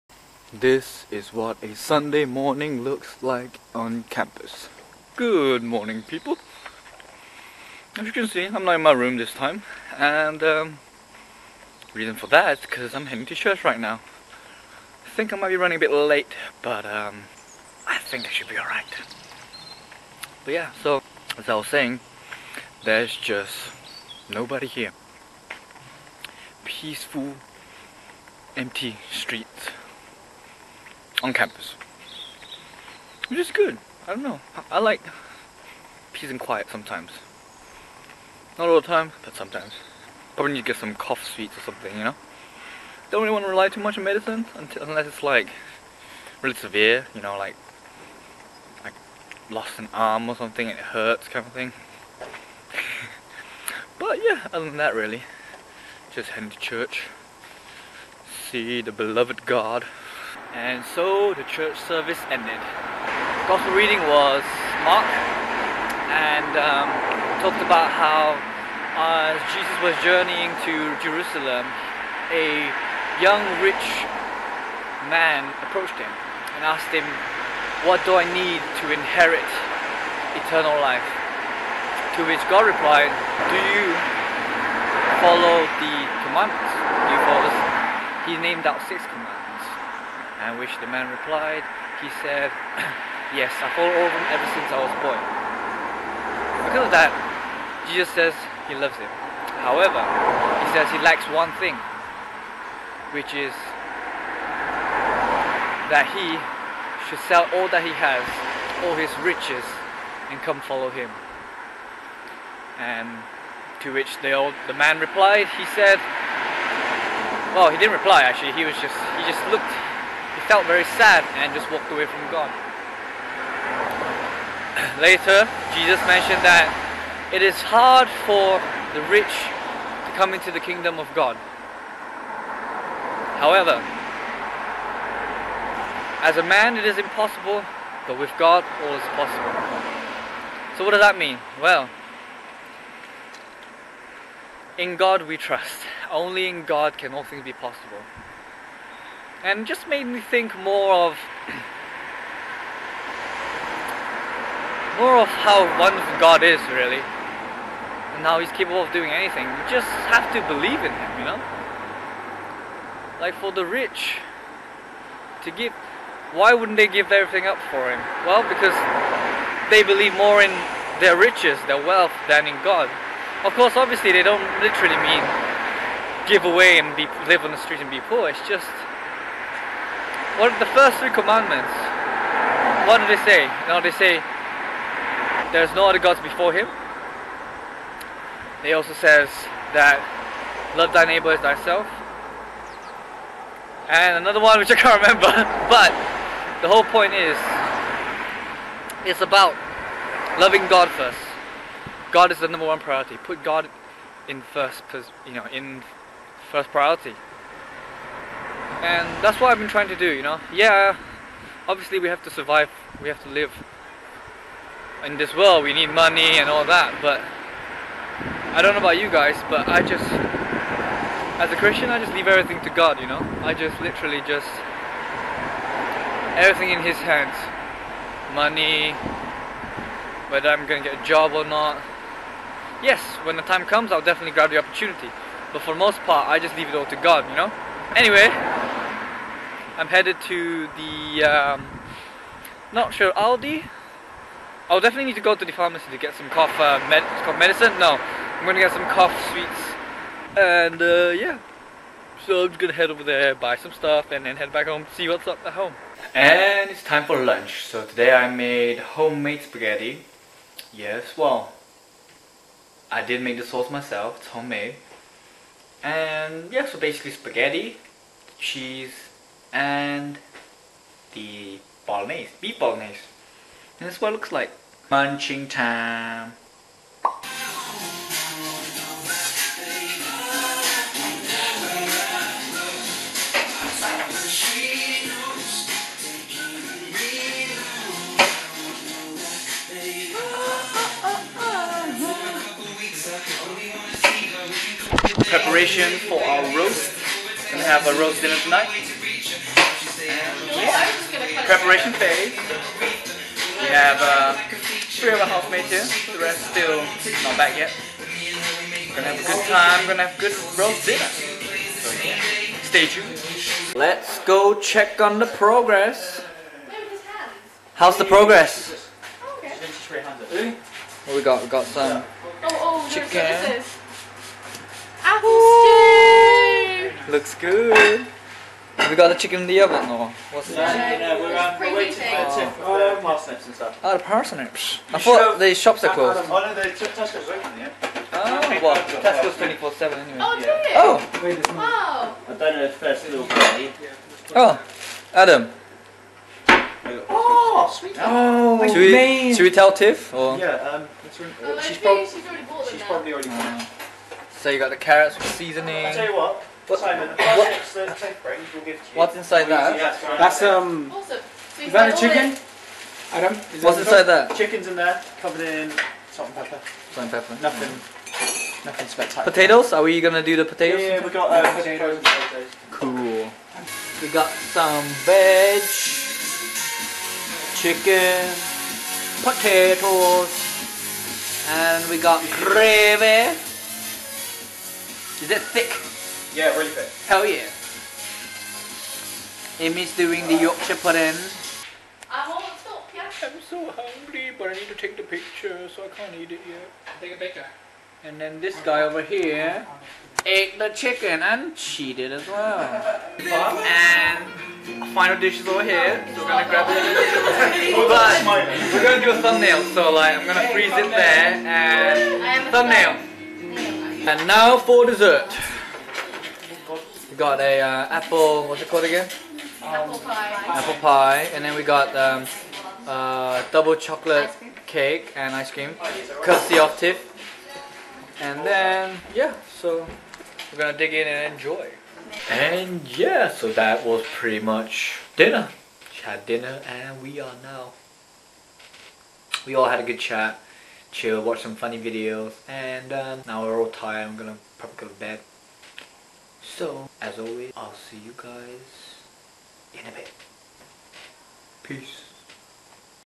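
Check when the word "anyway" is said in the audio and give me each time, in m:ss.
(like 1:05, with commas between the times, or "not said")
3:57, 5:39.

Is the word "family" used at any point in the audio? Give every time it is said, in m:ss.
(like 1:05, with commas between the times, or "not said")
not said.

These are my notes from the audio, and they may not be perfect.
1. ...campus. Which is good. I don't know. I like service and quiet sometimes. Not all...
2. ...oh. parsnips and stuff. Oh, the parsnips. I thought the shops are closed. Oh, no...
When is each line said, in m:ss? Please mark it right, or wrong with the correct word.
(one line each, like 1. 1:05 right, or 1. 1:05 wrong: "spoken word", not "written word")
1. 0:31 wrong: "peace", not "service"
2. 5:32 right.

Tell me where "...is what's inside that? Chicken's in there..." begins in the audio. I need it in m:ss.
6:03.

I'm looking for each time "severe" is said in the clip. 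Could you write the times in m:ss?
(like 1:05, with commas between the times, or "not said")
0:46.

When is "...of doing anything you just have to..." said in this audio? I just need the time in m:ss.
2:38.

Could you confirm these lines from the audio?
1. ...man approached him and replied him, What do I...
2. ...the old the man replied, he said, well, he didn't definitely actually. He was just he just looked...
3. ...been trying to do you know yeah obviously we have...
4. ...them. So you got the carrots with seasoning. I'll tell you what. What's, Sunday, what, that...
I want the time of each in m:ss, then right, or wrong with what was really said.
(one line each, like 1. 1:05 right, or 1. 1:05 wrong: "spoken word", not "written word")
1. 1:15 wrong: "asked", not "replied"
2. 1:54 wrong: "reply", not "definitely"
3. 3:29 right
4. 5:53 wrong: "Simon", not "Sunday".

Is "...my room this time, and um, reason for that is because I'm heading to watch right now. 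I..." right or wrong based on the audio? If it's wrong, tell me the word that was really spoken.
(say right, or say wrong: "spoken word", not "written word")
wrong: "church", not "watch".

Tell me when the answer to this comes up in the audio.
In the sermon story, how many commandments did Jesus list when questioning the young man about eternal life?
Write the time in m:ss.
1:28.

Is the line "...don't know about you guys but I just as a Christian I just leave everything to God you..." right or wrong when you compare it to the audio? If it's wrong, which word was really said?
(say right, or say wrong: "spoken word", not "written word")
right.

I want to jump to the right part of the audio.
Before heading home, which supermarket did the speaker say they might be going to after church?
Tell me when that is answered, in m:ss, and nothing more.
4:03.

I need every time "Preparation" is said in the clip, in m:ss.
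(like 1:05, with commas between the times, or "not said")
4:55, 5:01.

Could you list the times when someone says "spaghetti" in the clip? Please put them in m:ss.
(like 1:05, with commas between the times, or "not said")
4:19, 4:27.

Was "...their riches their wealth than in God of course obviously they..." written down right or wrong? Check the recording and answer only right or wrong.
right.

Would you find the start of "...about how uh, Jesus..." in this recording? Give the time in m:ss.
1:07.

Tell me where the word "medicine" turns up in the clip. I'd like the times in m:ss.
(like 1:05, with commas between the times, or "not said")
0:44, 4:07.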